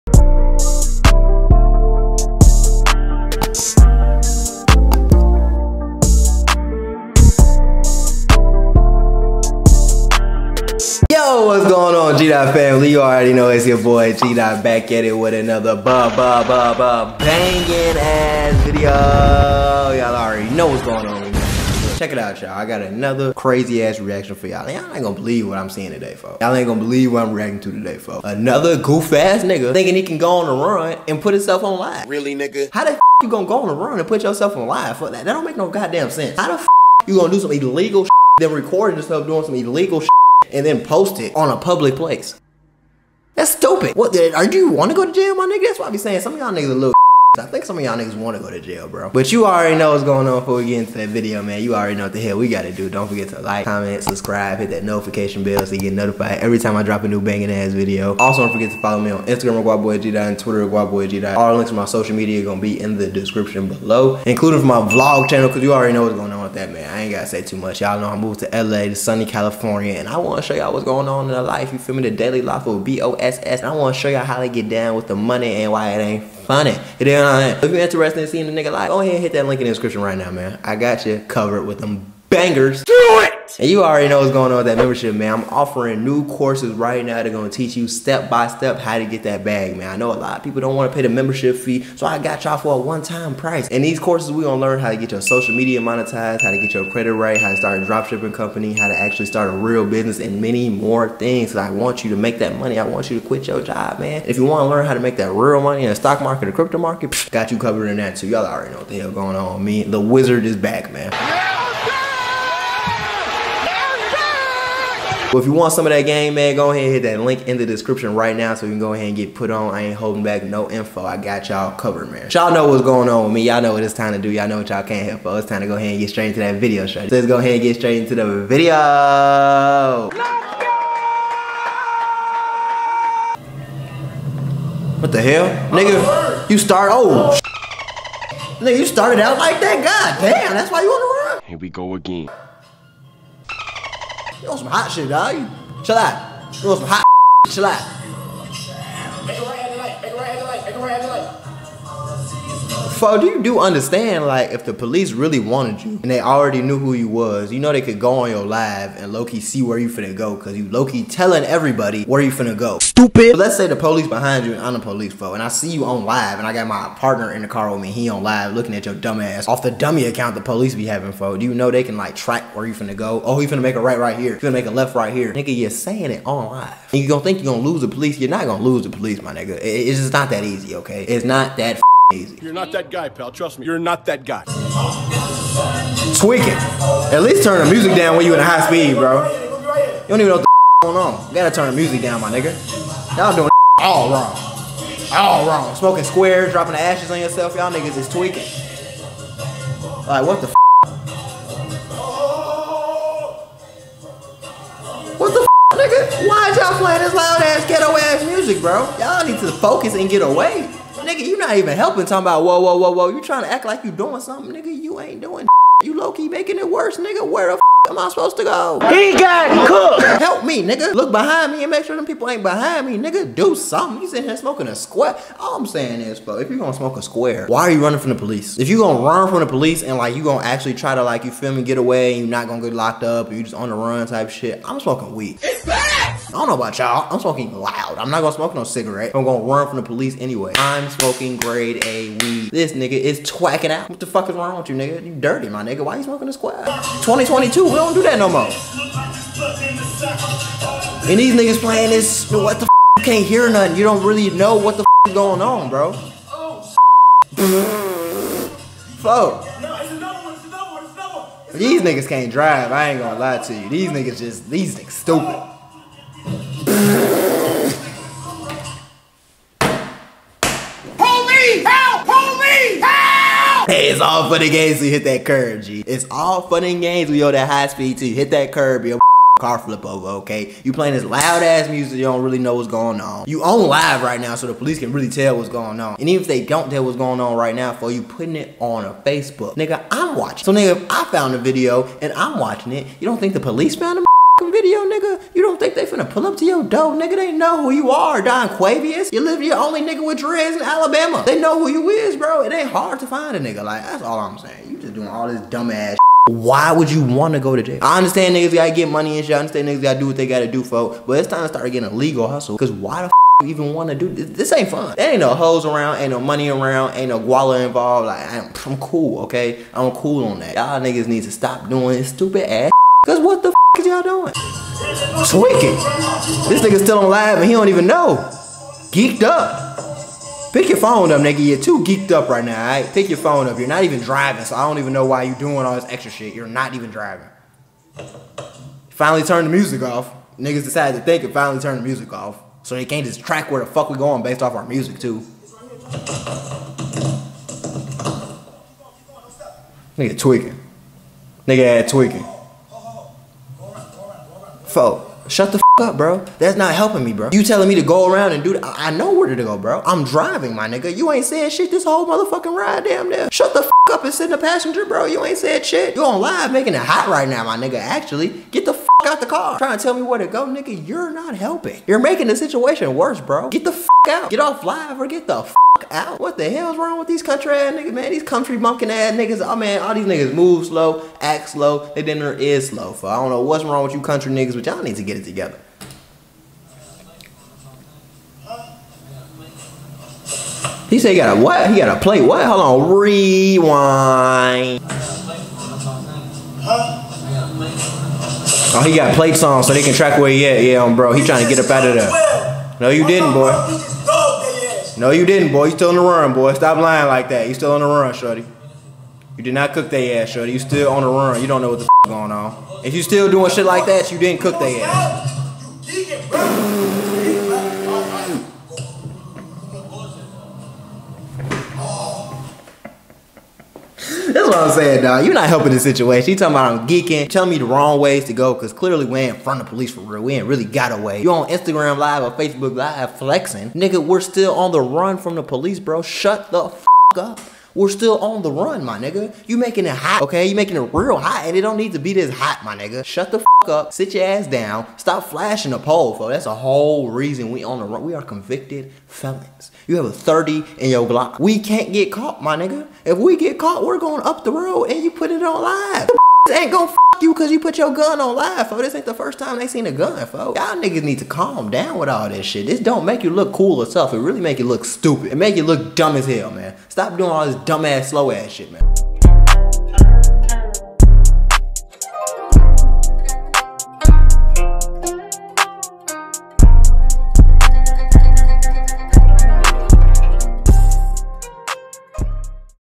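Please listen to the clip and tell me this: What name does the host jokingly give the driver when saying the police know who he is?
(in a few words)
Don Quavius.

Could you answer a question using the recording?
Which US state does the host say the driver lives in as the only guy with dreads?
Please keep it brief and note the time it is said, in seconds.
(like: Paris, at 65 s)
Alabama, at 300 s.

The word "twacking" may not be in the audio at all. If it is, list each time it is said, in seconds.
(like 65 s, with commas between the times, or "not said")
243 s.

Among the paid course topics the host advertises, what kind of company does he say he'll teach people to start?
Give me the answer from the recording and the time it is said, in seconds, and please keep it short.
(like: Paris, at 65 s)
Dropshipping company, at 97 s.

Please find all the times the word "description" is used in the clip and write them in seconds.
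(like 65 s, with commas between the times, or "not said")
63 s, 79 s, 117 s.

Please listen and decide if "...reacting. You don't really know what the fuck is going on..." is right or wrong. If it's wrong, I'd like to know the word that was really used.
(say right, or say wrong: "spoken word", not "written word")
wrong: "nothing", not "reacting".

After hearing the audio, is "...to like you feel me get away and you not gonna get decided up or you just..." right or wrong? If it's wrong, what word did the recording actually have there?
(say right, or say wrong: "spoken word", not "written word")
wrong: "locked", not "decided".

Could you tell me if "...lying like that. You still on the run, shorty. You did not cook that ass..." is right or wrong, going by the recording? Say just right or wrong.
right.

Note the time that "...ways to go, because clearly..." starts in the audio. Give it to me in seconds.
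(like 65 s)
427 s.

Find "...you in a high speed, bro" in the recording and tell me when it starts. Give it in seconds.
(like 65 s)
188 s.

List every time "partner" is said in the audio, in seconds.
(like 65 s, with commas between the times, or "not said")
166 s.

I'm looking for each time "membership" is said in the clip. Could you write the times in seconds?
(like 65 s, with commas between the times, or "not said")
84 s, 91 s.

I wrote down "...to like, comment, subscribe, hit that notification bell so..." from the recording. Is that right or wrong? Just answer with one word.
right.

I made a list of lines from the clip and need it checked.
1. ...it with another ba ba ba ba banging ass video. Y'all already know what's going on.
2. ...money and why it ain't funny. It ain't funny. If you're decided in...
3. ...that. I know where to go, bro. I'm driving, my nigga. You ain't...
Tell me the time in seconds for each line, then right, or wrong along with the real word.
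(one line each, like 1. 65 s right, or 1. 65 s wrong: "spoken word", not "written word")
1. 15 s right
2. 75 s wrong: "interested", not "decided"
3. 358 s right.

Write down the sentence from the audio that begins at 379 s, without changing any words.
Oh man, all these niggas move slow, act slow, they dinner is slow.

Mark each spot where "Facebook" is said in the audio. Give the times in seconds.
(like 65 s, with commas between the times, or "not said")
288 s, 432 s.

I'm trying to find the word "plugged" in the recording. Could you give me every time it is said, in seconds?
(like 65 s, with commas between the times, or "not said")
not said.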